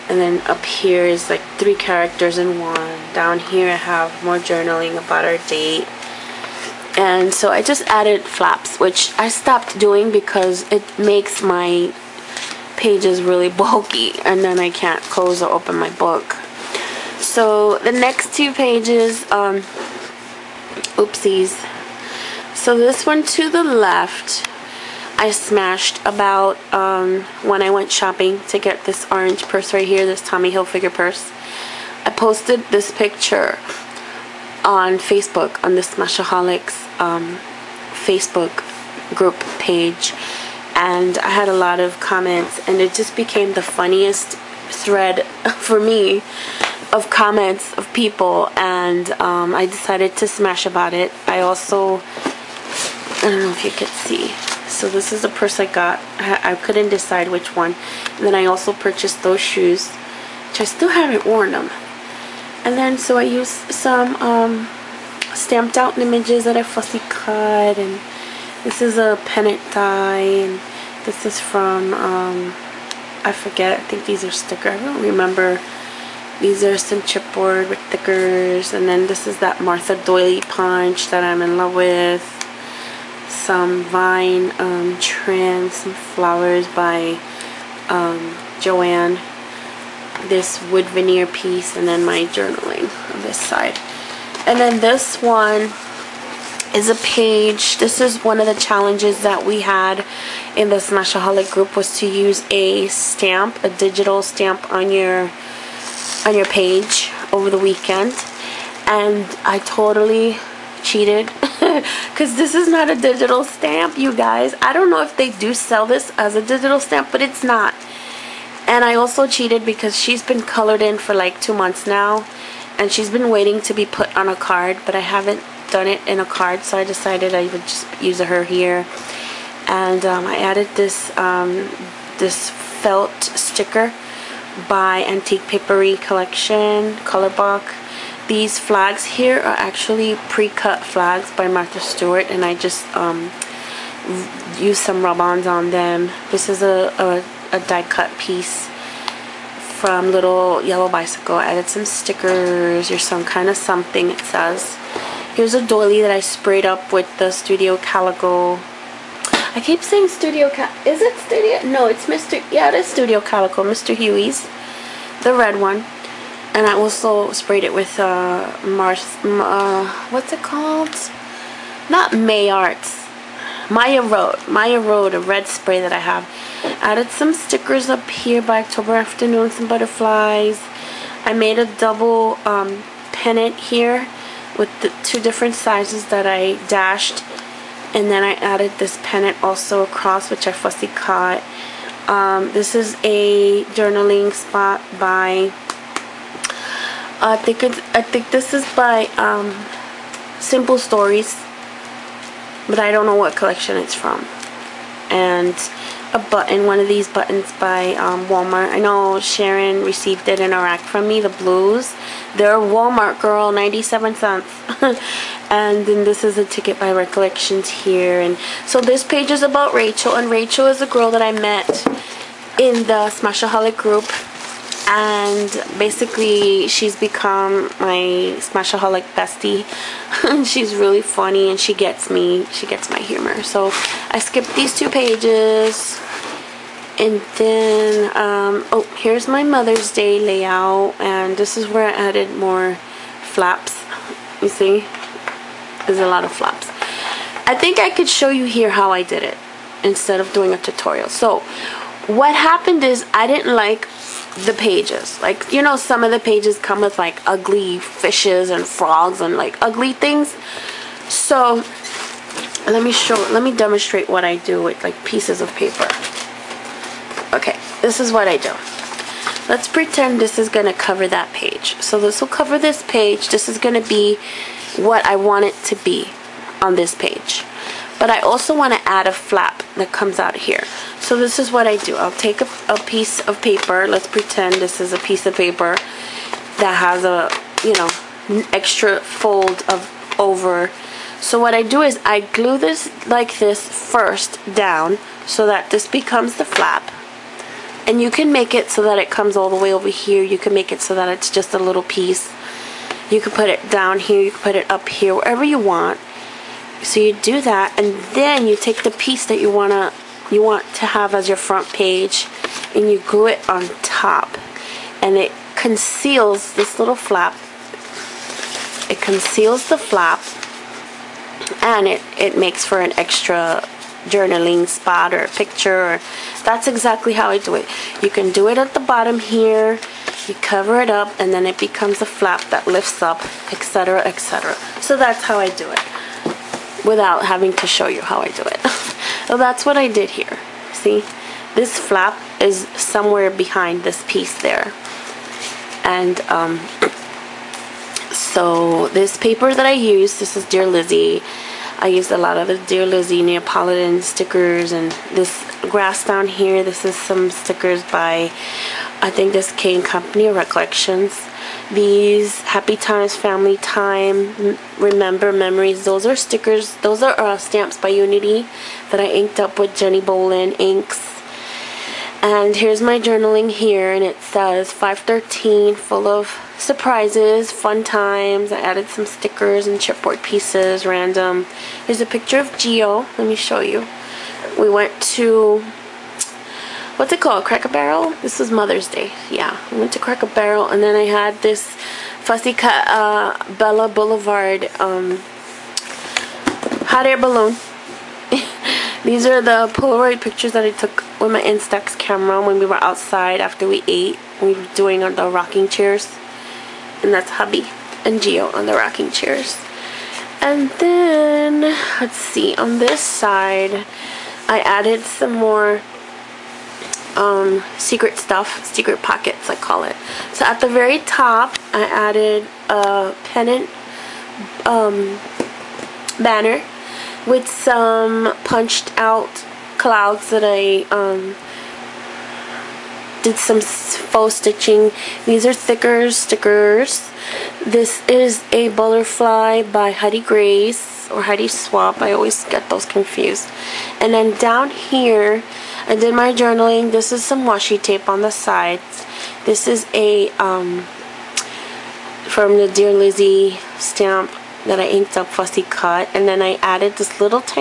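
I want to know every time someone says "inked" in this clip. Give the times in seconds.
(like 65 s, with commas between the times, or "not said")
369 s, 454 s.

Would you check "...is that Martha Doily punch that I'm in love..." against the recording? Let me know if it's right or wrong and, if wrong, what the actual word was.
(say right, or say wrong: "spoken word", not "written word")
right.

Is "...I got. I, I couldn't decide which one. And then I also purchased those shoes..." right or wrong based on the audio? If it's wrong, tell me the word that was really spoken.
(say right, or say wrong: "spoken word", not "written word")
right.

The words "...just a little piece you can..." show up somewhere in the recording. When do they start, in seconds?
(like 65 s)
301 s.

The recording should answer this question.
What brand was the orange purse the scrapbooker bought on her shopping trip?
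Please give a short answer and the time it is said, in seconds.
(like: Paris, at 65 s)
Tommy Hilfiger, at 30 s.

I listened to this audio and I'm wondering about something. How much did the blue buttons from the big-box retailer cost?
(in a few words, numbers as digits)
97 cents.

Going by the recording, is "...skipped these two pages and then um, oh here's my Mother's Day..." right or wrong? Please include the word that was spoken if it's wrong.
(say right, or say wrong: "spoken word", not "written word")
right.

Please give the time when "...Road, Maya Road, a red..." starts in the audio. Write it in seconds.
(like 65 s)
174 s.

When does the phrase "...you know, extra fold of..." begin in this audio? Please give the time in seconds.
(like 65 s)
287 s.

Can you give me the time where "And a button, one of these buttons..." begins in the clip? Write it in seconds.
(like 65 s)
205 s.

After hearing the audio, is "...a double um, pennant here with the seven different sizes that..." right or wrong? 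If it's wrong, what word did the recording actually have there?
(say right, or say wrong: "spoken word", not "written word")
wrong: "two", not "seven".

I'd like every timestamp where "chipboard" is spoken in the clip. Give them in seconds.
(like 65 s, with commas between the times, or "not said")
77 s, 379 s.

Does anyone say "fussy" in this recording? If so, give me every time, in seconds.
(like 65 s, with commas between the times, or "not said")
66 s, 190 s, 392 s, 455 s.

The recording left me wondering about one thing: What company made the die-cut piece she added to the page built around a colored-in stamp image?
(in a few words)
Little Yellow Bicycle.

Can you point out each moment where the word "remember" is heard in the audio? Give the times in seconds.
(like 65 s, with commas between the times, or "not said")
75 s, 364 s.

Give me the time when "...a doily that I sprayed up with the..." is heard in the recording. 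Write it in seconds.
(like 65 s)
155 s.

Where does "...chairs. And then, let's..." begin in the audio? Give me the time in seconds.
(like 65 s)
409 s.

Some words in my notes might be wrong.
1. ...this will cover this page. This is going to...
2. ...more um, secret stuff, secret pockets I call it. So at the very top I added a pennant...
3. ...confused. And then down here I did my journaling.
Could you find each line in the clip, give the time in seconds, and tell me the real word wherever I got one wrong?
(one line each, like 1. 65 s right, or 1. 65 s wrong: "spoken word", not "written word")
1. 271 s right
2. 415 s right
3. 442 s right.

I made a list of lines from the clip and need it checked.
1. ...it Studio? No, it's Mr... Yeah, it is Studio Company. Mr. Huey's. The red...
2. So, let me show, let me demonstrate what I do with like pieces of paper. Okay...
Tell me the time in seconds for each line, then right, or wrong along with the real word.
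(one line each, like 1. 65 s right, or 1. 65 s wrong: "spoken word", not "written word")
1. 161 s wrong: "Calico", not "Company"
2. 261 s right.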